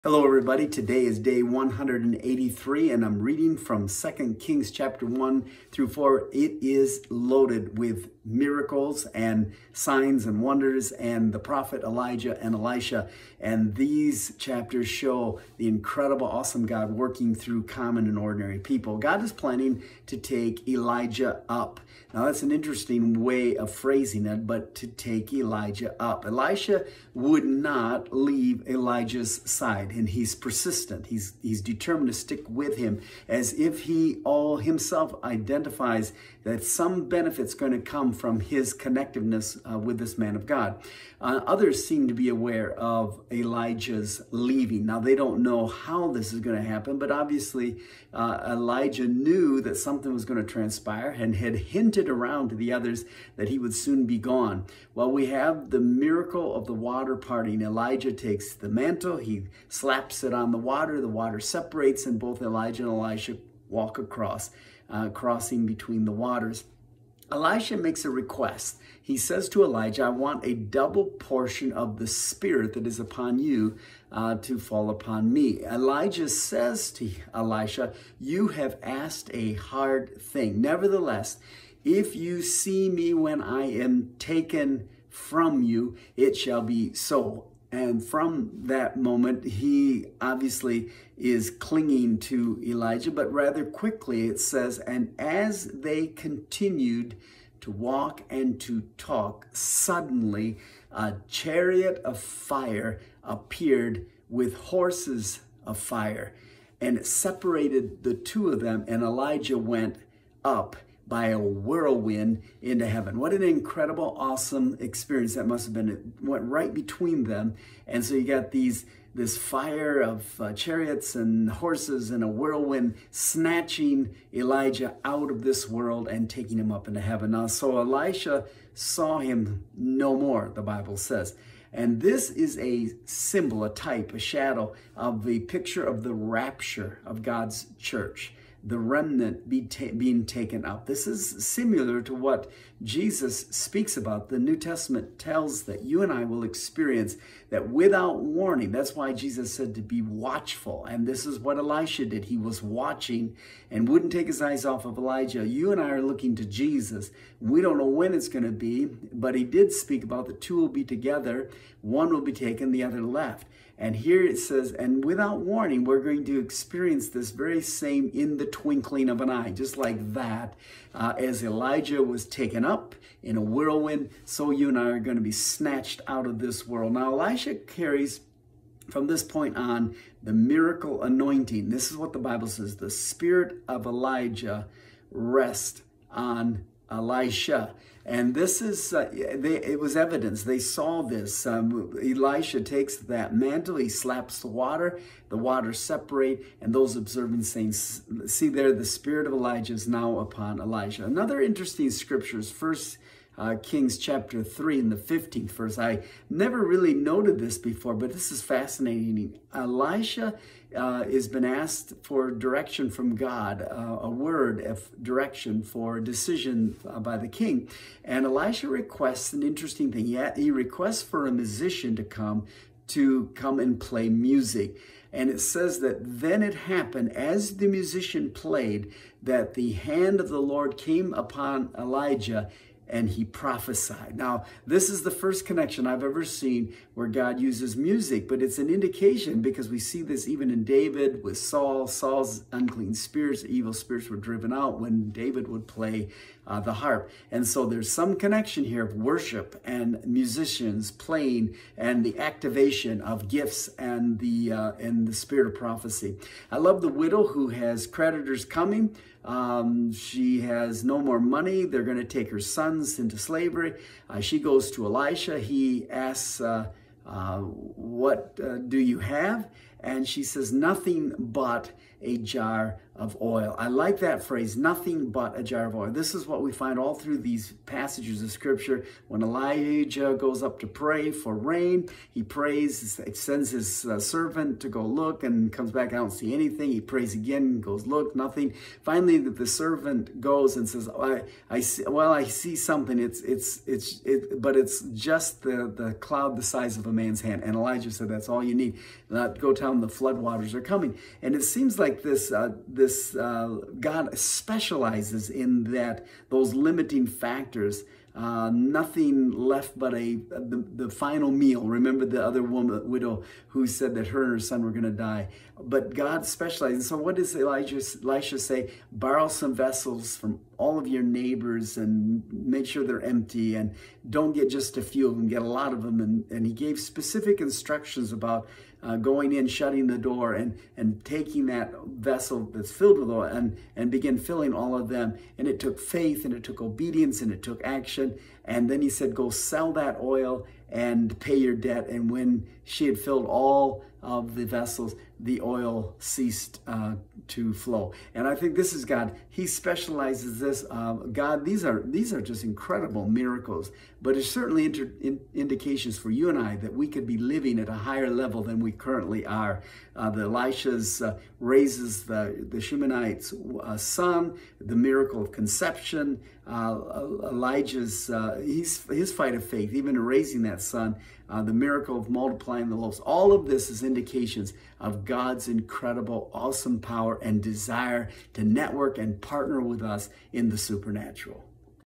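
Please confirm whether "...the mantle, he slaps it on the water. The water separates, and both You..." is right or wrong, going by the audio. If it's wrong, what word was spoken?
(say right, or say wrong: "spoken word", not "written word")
wrong: "Elijah", not "You".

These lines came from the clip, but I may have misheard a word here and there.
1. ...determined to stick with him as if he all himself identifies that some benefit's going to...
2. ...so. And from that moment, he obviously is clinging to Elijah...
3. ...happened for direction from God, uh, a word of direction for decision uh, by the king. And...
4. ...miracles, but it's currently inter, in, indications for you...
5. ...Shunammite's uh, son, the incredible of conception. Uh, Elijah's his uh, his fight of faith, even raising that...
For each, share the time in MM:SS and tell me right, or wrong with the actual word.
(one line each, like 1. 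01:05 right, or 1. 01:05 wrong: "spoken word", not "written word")
1. 00:31 right
2. 01:26 right
3. 03:31 wrong: "asked", not "happened"
4. 05:53 wrong: "certainly", not "currently"
5. 06:02 wrong: "miracle", not "incredible".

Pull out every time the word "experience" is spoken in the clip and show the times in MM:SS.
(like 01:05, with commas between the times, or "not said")
01:54, 02:26, 02:46.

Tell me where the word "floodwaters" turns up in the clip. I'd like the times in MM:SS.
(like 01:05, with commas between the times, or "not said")
04:59.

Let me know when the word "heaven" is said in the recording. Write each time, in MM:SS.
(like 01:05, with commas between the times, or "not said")
01:52, 02:07.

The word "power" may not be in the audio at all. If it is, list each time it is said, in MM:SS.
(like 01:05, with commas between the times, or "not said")
06:16.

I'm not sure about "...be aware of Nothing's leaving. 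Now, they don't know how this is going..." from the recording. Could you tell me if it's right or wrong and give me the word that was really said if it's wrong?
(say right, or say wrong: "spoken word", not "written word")
wrong: "Elijah", not "Nothing".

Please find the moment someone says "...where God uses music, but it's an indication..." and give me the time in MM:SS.
03:56.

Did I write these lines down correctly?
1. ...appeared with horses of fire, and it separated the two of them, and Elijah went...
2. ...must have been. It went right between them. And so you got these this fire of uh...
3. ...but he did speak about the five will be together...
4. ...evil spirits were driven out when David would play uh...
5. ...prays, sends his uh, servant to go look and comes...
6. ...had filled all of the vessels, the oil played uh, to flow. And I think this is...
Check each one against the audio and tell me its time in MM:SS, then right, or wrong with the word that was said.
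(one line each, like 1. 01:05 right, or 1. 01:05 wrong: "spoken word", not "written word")
1. 01:43 right
2. 01:55 right
3. 02:38 wrong: "two", not "five"
4. 04:03 right
5. 04:42 right
6. 05:42 wrong: "ceased", not "played".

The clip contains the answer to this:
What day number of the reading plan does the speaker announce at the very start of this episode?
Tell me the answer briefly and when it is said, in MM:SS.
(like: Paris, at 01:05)
183, at 00:01.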